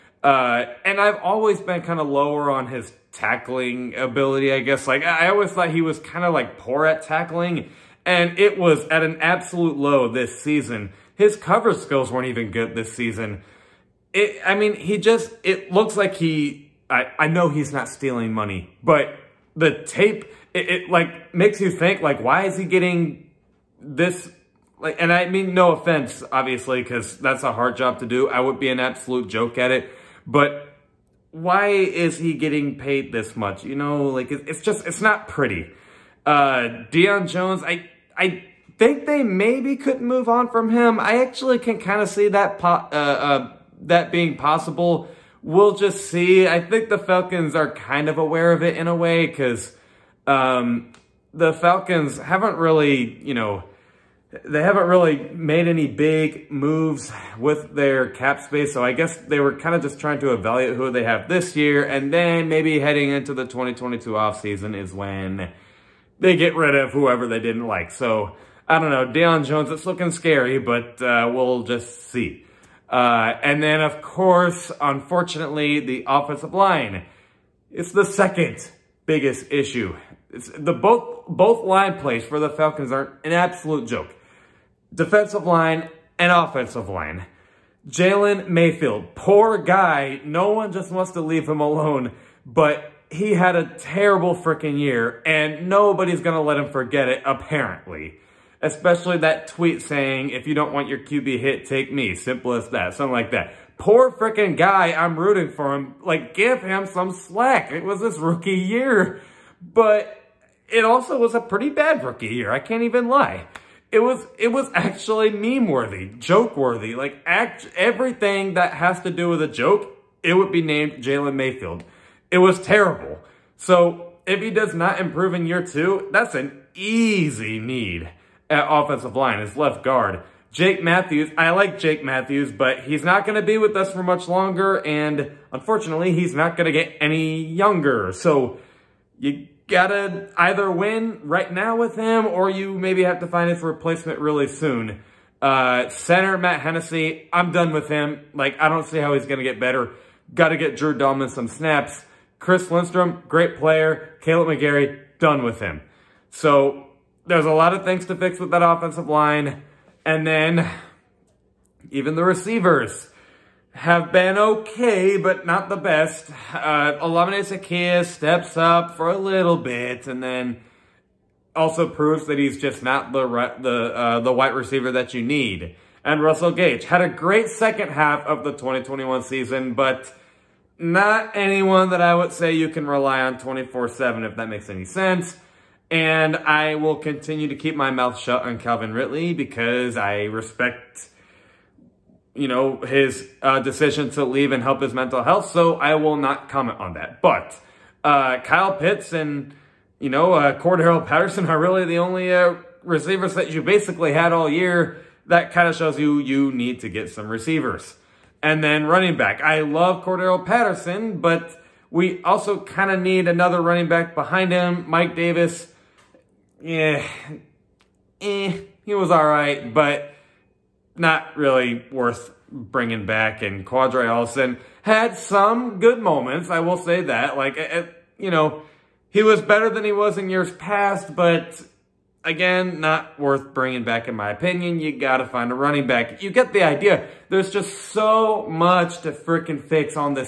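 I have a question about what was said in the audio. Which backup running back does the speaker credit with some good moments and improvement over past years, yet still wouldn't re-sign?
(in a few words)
Qadree Ollison.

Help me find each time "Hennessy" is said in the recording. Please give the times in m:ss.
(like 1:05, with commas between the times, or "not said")
2:26.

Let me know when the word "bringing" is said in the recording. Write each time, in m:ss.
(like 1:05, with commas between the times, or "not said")
3:42, 3:53.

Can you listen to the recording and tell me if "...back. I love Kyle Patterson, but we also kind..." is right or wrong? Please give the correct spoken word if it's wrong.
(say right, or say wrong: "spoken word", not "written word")
wrong: "Cordarrelle", not "Kyle".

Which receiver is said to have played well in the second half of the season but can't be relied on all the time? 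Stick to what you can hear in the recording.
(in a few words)
Russell Gage.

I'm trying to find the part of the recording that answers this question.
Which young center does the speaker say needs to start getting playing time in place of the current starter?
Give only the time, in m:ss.
2:30.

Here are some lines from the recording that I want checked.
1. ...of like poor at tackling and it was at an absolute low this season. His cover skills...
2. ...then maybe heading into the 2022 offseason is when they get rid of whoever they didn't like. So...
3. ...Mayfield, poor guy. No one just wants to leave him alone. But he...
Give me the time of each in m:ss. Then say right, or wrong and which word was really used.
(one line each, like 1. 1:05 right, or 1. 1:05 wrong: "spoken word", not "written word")
1. 0:06 right
2. 1:02 right
3. 1:28 right.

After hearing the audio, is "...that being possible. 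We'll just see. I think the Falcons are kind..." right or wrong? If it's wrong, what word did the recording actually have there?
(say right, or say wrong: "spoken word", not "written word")
right.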